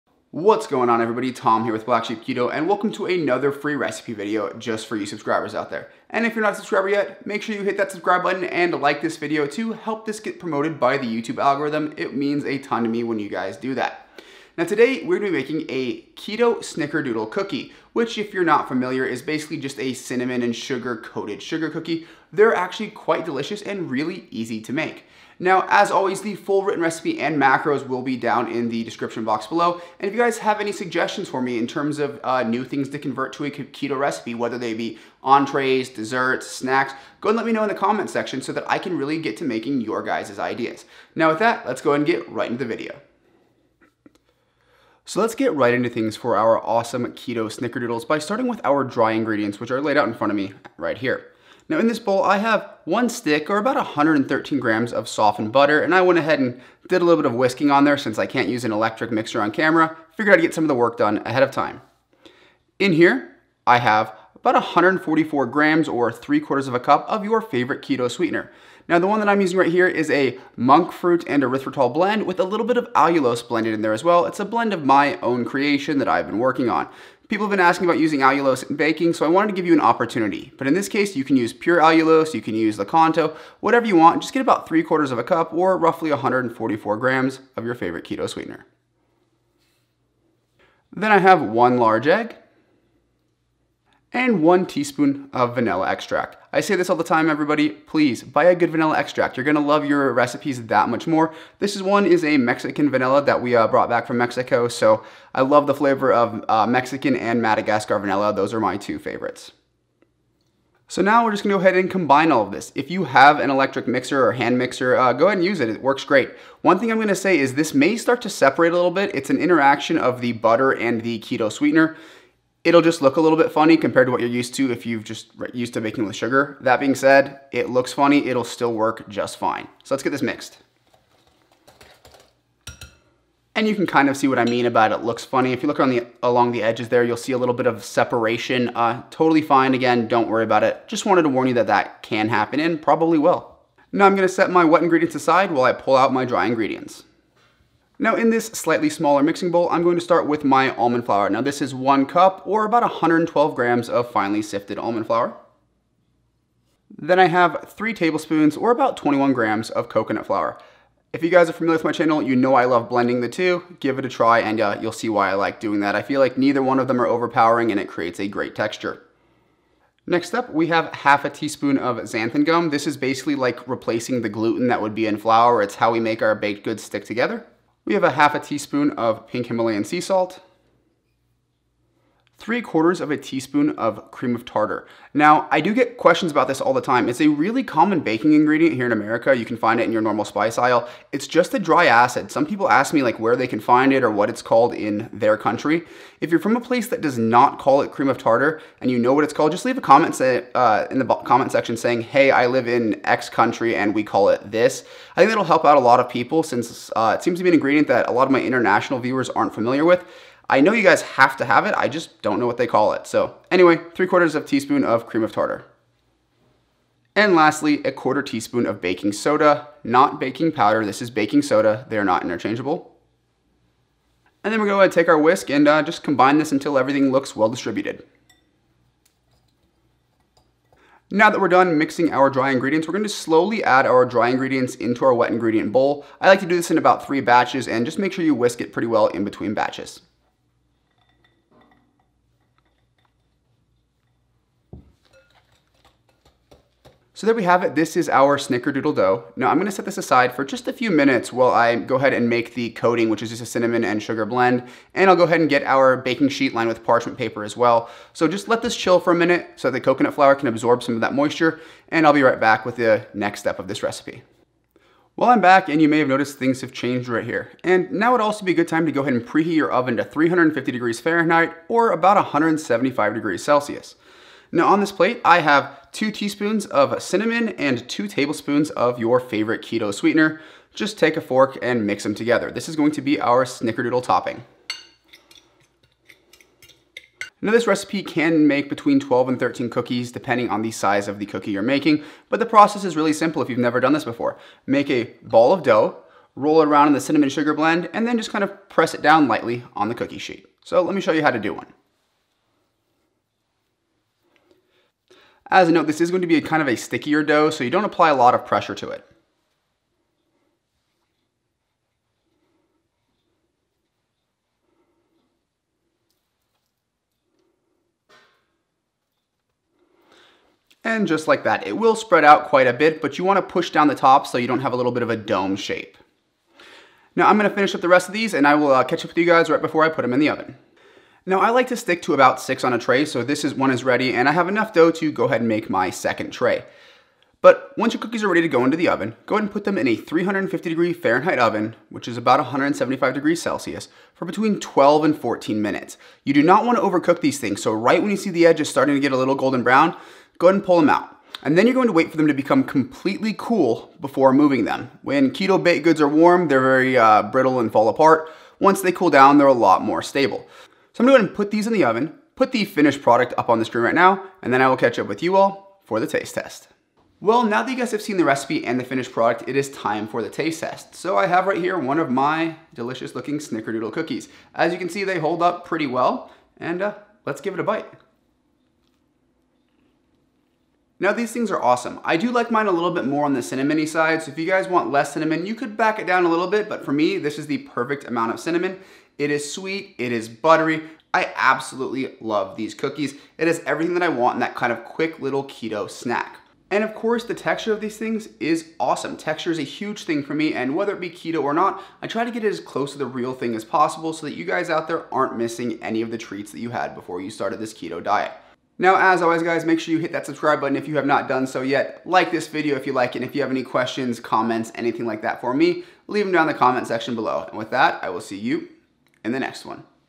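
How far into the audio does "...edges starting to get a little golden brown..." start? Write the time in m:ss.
5:48.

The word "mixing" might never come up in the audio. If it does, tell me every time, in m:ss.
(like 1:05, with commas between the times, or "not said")
2:29, 3:51.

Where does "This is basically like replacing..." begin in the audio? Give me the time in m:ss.
2:52.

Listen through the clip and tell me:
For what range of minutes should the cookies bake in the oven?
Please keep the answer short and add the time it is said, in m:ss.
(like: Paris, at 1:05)
12 to 14 minutes, at 5:44.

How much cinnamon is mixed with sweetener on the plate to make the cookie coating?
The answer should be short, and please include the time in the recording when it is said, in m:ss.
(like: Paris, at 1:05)
2 teaspoons, at 4:35.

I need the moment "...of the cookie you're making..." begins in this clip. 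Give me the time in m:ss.
4:51.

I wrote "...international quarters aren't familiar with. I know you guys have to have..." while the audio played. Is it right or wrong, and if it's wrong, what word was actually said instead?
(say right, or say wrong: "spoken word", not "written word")
wrong: "viewers", not "quarters".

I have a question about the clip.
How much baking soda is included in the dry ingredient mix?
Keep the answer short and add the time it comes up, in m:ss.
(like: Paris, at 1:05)
A quarter teaspoon, at 3:37.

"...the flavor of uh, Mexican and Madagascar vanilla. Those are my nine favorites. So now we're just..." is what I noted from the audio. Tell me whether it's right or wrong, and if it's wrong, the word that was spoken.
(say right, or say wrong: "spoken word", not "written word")
wrong: "two", not "nine".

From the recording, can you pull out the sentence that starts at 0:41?
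Now with that, let's go and get right into the video.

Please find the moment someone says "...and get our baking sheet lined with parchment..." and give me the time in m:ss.
4:15.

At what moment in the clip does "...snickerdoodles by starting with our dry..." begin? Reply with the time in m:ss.
0:47.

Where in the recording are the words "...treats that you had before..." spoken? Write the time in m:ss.
6:46.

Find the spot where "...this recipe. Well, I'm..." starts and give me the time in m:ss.
4:23.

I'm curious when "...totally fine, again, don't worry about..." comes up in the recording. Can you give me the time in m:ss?
2:19.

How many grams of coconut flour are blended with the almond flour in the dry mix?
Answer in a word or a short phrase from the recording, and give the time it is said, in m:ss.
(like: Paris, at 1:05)
21 grams, at 2:38.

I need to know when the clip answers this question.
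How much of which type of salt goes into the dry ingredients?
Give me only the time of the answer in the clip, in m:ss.
2:58.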